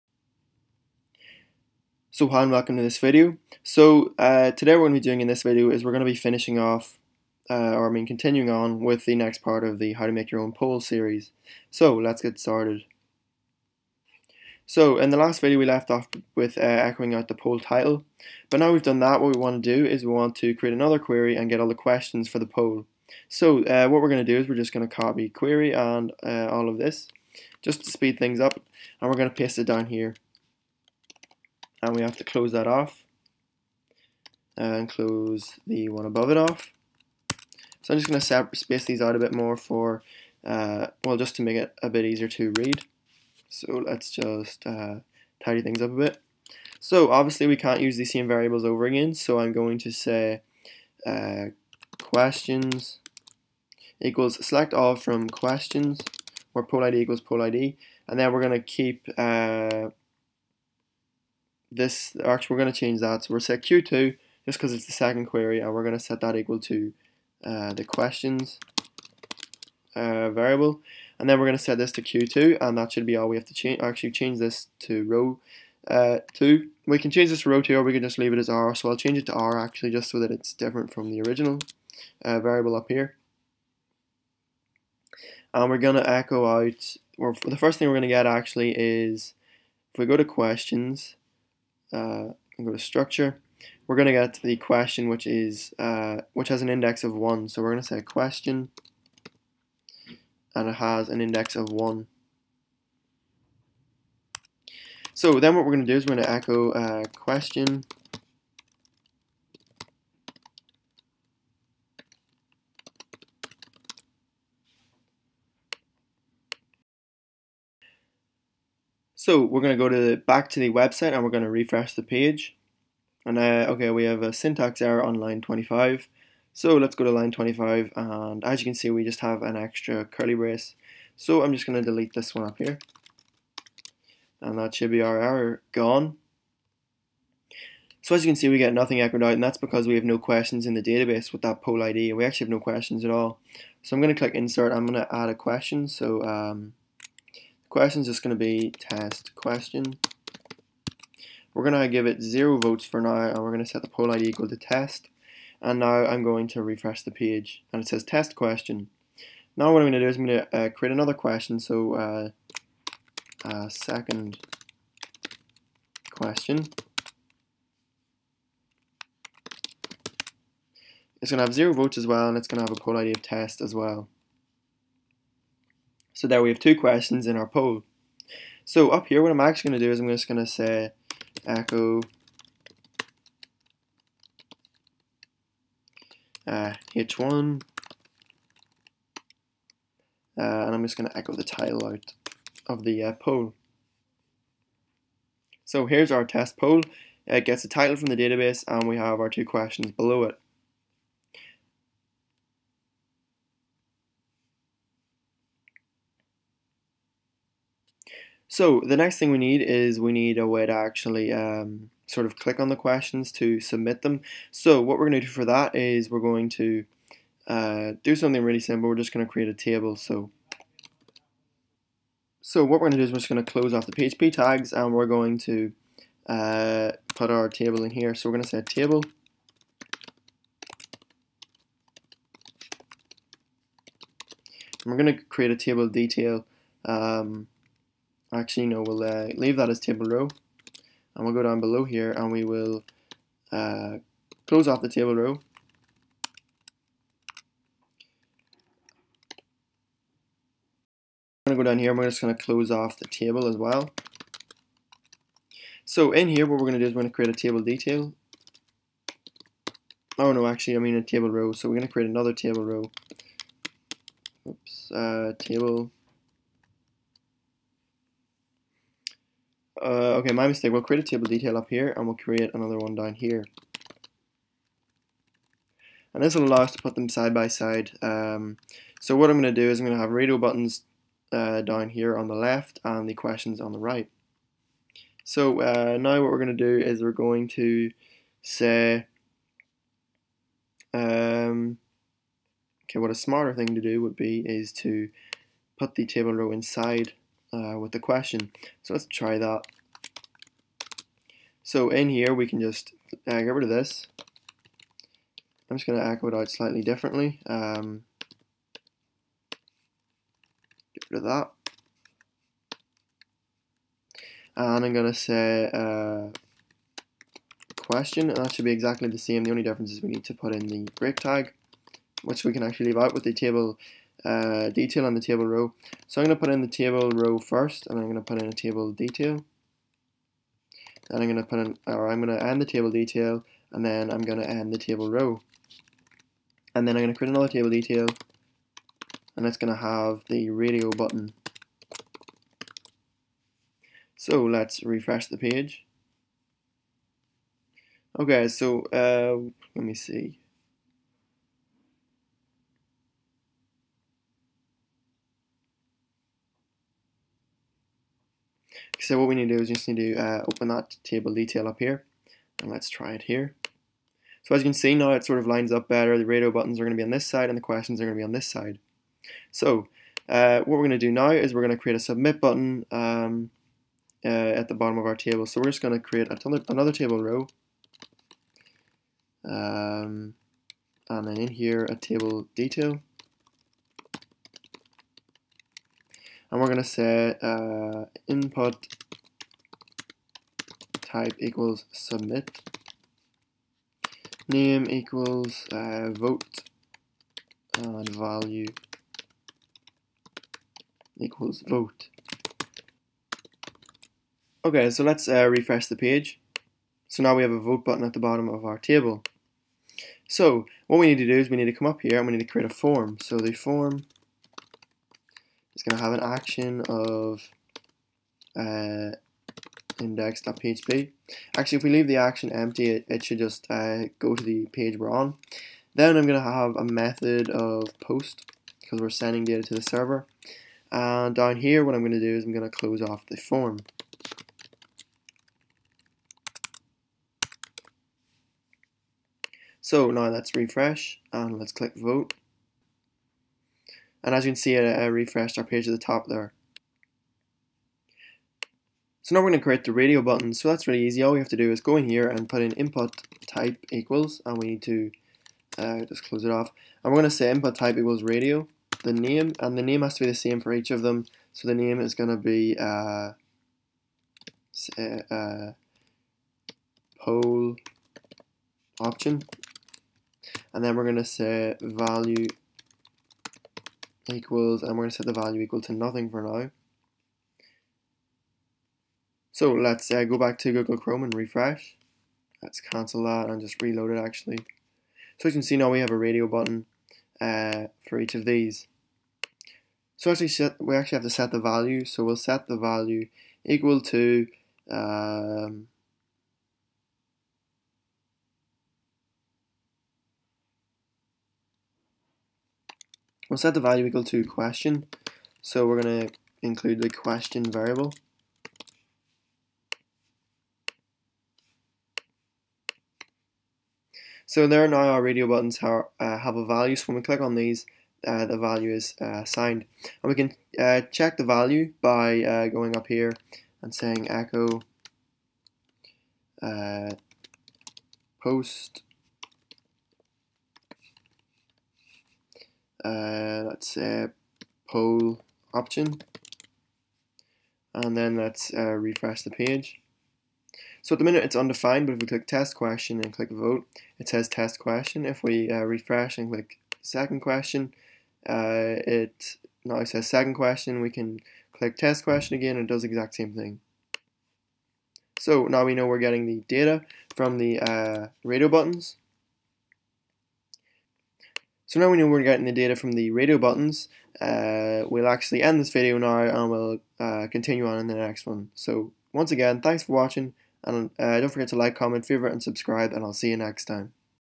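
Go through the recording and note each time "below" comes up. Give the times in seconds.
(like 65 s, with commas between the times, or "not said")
199 s, 241 s.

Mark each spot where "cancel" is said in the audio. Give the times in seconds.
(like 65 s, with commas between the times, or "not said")
482 s.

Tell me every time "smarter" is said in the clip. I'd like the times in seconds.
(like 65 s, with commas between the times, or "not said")
293 s.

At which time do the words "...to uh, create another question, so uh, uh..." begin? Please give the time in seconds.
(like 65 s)
160 s.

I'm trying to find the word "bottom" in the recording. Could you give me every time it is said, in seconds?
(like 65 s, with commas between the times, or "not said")
374 s, 408 s.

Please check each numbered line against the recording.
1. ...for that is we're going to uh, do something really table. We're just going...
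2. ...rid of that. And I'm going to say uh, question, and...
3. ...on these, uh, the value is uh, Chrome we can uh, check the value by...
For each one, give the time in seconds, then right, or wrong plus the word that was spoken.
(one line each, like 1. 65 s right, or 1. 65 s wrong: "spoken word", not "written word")
1. 215 s wrong: "simple", not "table"
2. 311 s right
3. 517 s wrong: "And", not "Chrome".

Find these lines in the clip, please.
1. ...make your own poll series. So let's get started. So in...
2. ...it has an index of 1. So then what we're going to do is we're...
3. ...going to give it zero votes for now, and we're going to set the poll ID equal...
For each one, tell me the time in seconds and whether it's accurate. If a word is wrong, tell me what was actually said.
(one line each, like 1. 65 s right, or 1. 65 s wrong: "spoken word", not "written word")
1. 10 s right
2. 100 s right
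3. 151 s right.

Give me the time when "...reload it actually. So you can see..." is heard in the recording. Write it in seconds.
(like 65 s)
483 s.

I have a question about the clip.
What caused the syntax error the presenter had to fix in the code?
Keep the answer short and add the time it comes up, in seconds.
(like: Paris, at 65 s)
An extra curly brace, at 129 s.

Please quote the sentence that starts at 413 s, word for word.
So the form it's going to have an action of uh, index.php.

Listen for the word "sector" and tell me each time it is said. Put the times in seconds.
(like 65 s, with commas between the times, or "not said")
not said.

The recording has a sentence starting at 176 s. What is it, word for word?
So there we have two questions in our poll.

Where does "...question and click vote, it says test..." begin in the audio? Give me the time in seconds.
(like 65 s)
542 s.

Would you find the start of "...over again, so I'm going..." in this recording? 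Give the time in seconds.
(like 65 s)
48 s.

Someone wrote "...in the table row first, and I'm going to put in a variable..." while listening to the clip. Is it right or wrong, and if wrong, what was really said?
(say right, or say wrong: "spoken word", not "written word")
wrong: "table", not "variable".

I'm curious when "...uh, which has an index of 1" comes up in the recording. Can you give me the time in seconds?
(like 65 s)
95 s.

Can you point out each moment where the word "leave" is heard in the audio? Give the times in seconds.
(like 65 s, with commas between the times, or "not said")
78 s, 239 s, 322 s, 421 s.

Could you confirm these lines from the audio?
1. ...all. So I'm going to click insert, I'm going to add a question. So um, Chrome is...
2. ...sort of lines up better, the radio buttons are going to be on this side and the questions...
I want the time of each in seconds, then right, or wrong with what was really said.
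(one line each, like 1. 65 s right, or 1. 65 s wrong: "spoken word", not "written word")
1. 143 s wrong: "Question", not "Chrome"
2. 365 s right.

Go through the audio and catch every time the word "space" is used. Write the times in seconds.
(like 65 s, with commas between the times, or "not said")
38 s.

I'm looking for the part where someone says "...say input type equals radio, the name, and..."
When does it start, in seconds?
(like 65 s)
457 s.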